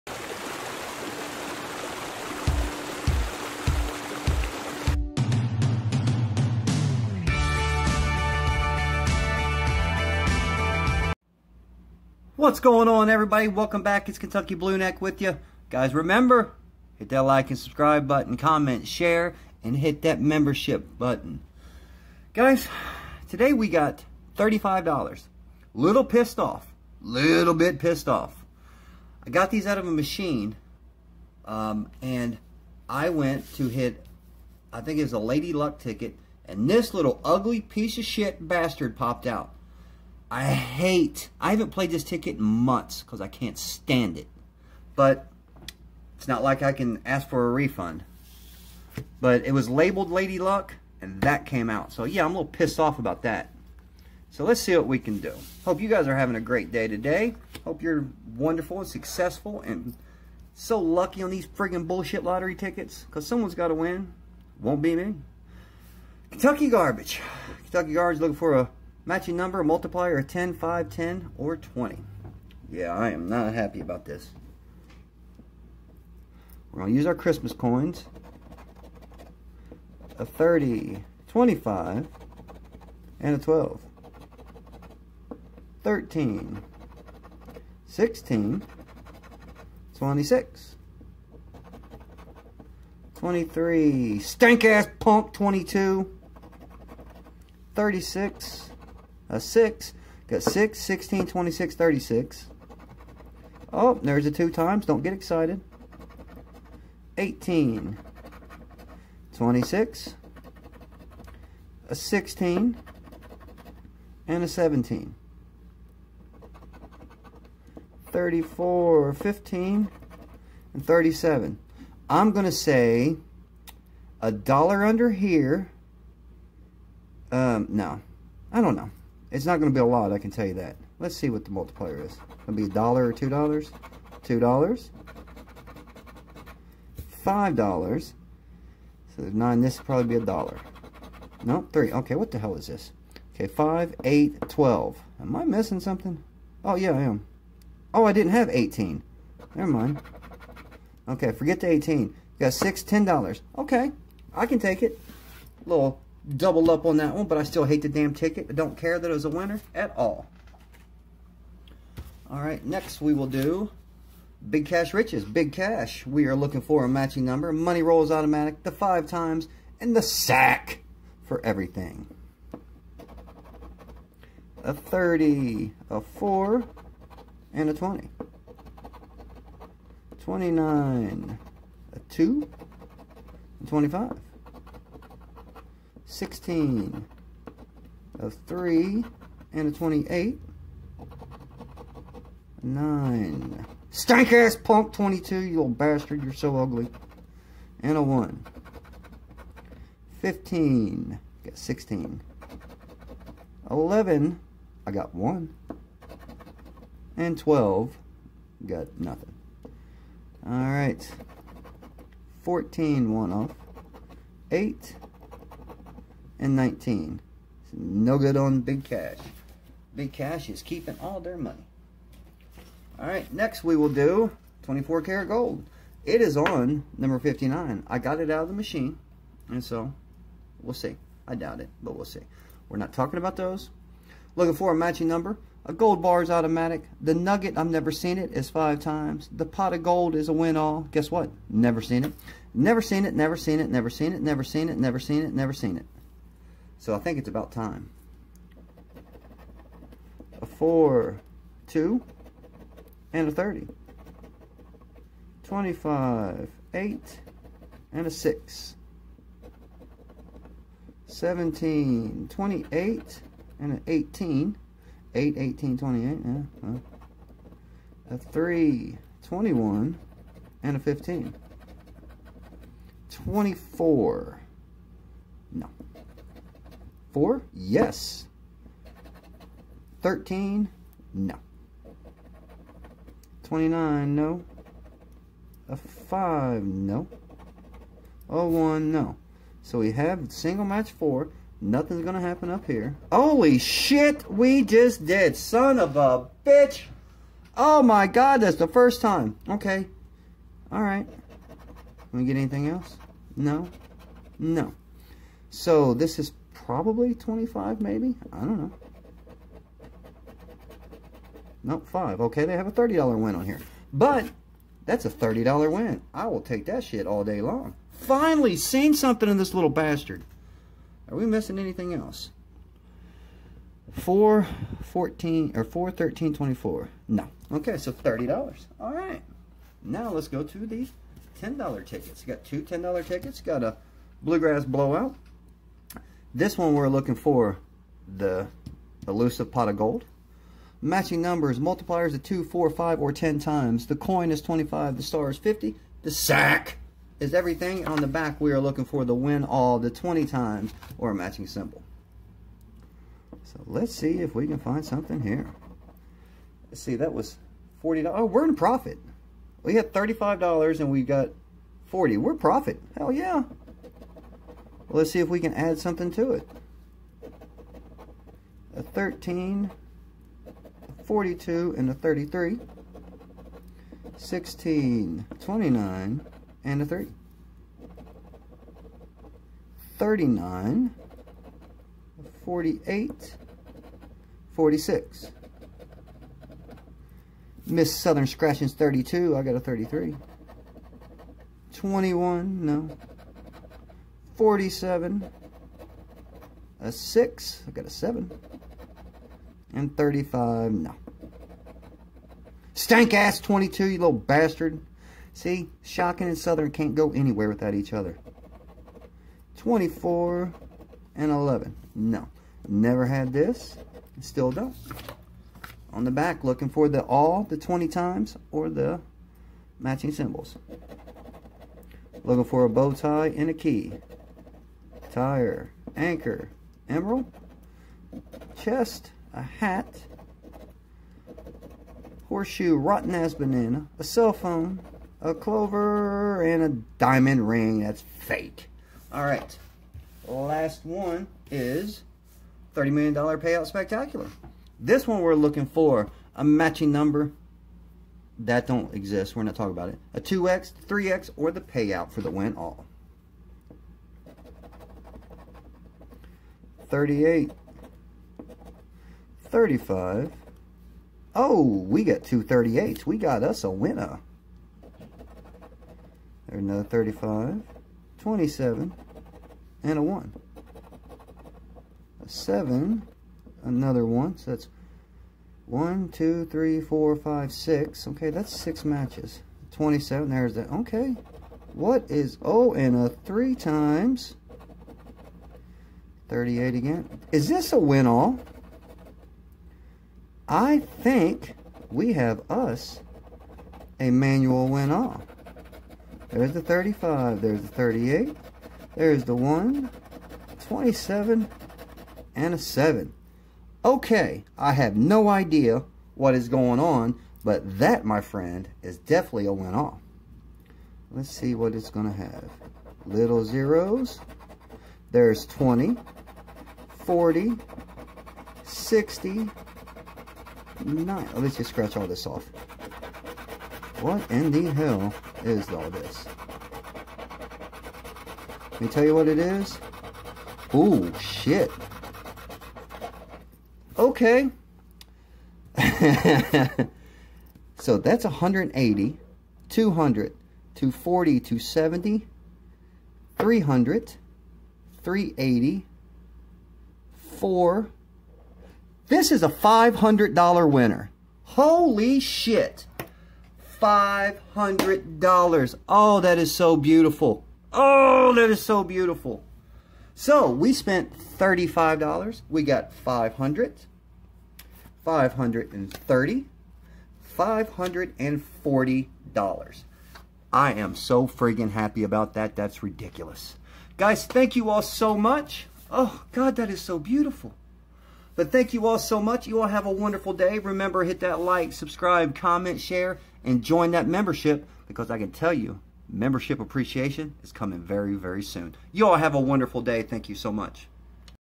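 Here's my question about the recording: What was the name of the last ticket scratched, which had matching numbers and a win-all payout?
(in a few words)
$30 million payout spectacular.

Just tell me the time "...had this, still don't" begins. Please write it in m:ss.
6:53.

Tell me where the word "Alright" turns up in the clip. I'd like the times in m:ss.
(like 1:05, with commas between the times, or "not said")
3:30, 5:00.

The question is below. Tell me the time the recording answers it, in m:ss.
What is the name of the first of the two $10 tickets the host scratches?
5:34.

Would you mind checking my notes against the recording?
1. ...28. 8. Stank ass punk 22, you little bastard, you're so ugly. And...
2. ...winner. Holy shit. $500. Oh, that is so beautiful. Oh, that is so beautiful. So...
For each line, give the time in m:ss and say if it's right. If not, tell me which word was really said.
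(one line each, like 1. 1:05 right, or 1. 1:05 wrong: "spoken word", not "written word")
1. 3:09 wrong: "9", not "8"
2. 9:10 right.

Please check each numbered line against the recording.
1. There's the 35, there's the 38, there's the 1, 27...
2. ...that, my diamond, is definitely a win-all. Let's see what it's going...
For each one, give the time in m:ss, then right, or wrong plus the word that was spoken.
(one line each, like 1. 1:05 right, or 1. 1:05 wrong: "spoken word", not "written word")
1. 8:16 right
2. 8:27 wrong: "friend", not "diamond".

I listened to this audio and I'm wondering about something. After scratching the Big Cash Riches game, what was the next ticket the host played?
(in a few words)
24 karat gold.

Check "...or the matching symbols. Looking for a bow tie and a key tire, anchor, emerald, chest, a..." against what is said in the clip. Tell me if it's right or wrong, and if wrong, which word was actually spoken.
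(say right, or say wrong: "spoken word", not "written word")
right.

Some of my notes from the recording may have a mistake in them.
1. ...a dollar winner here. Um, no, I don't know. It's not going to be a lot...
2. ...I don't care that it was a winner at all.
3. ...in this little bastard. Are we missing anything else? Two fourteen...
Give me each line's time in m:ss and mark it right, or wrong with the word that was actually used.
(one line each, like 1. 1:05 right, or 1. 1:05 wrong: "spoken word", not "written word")
1. 2:04 wrong: "under", not "winner"
2. 2:38 right
3. 5:19 wrong: "Four", not "Two".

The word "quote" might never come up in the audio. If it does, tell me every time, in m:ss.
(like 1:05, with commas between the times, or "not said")
not said.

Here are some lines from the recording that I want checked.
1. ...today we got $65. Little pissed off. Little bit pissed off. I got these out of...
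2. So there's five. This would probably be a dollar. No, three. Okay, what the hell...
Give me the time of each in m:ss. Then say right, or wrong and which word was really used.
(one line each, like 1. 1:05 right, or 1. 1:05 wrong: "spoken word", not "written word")
1. 0:23 wrong: "35", not "65"
2. 2:19 wrong: "nine", not "five".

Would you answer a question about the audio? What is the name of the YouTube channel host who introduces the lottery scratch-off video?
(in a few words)
Kentucky Blue Neck.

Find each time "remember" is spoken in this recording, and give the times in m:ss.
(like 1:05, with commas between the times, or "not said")
0:15, 9:40.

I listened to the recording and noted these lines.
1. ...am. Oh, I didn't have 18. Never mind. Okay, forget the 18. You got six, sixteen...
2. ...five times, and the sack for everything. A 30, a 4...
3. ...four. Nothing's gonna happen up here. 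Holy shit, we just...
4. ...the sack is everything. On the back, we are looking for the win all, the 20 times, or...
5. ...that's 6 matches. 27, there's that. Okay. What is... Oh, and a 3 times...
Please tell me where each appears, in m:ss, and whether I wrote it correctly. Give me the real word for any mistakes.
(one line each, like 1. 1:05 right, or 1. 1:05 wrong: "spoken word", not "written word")
1. 2:27 wrong: "ten", not "sixteen"
2. 2:48 right
3. 4:50 right
4. 5:46 right
5. 7:58 right.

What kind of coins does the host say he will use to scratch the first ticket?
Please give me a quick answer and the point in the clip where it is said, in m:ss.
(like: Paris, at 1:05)
Christmas coins, at 1:17.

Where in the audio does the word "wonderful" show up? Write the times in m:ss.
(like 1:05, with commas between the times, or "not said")
0:58, 9:39, 9:49.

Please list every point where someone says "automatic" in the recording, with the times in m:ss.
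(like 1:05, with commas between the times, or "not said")
2:48, 3:56.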